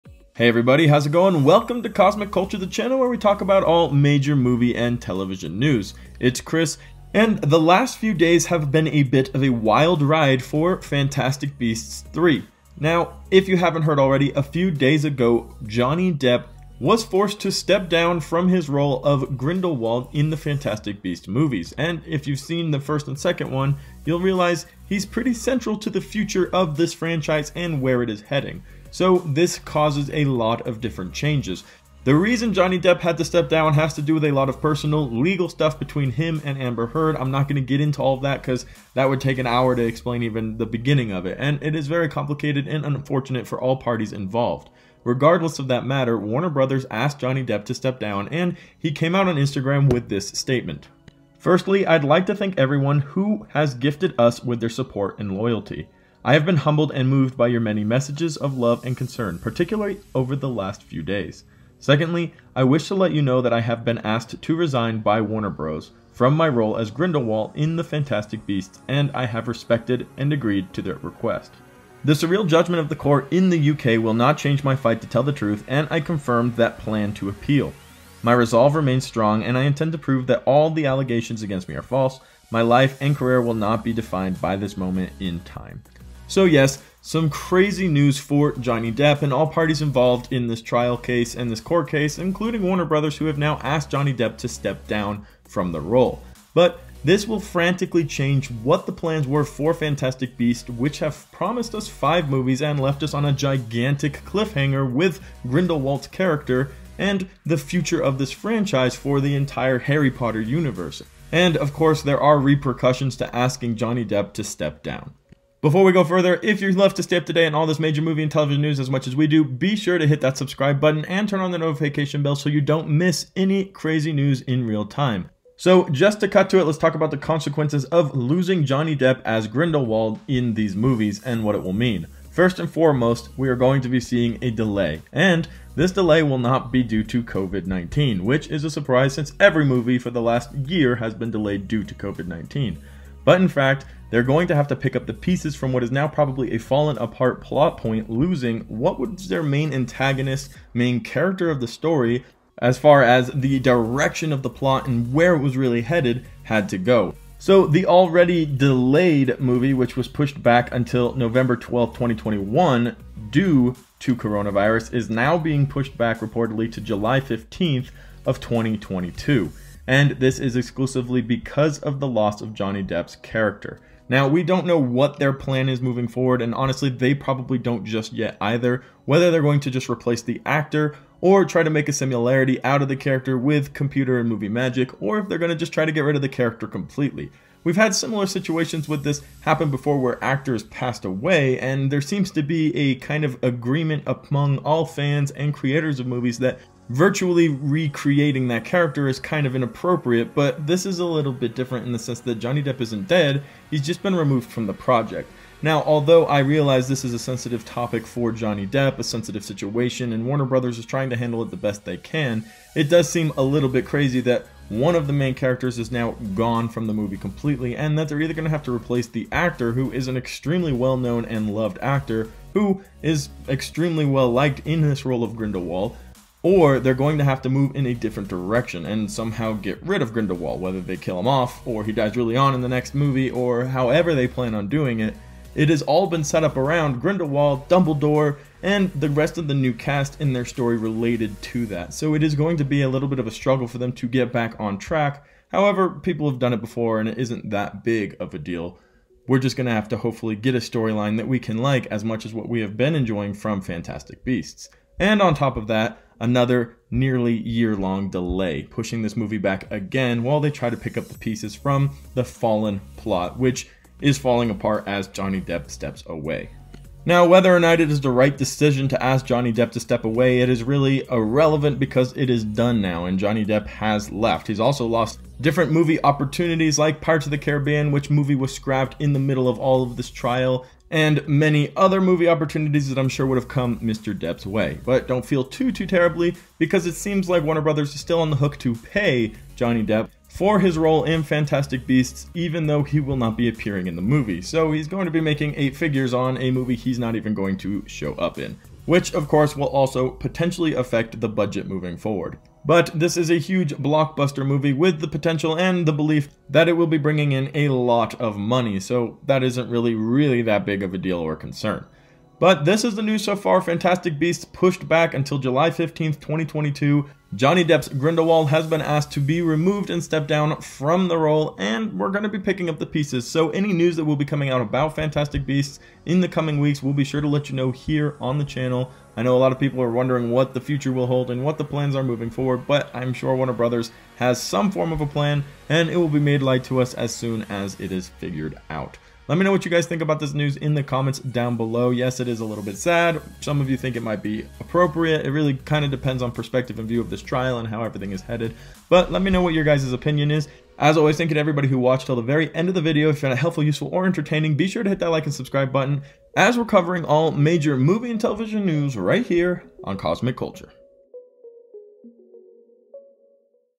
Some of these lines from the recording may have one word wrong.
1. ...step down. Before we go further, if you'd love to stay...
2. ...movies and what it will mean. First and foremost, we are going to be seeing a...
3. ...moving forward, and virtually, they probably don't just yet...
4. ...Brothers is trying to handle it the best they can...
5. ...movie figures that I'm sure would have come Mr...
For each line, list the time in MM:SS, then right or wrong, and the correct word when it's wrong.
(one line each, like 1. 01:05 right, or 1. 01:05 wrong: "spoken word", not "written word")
1. 01:54 right
2. 02:10 right
3. 02:55 wrong: "honestly", not "virtually"
4. 03:30 right
5. 04:42 wrong: "opportunities", not "figures".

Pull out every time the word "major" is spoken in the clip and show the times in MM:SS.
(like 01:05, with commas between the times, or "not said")
00:03, 01:57, 05:57.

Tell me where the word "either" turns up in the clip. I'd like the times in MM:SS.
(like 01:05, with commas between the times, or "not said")
02:58, 03:38.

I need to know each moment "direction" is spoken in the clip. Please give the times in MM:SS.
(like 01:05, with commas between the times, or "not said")
02:33, 03:48.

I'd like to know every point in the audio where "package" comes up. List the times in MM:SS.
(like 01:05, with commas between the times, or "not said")
not said.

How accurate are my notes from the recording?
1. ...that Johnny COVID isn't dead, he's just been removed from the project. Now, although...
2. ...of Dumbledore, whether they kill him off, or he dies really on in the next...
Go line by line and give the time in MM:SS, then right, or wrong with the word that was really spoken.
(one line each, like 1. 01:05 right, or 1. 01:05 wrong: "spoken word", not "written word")
1. 03:22 wrong: "Depp", not "COVID"
2. 03:50 wrong: "Grindelwald", not "Dumbledore".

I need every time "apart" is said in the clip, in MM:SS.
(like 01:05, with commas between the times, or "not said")
02:26, 04:24.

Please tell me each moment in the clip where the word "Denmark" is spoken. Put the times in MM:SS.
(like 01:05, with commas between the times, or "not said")
not said.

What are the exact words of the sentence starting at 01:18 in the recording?
My resolve remains strong, and I intend to prove that all the allegations against me are false.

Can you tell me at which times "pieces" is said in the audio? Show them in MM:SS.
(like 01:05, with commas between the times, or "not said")
02:25, 04:21, 05:22.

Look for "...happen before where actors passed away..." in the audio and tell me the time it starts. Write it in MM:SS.
03:09.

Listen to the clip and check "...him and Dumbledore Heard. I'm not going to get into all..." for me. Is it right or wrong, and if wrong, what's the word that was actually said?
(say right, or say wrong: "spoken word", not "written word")
wrong: "Amber", not "Dumbledore".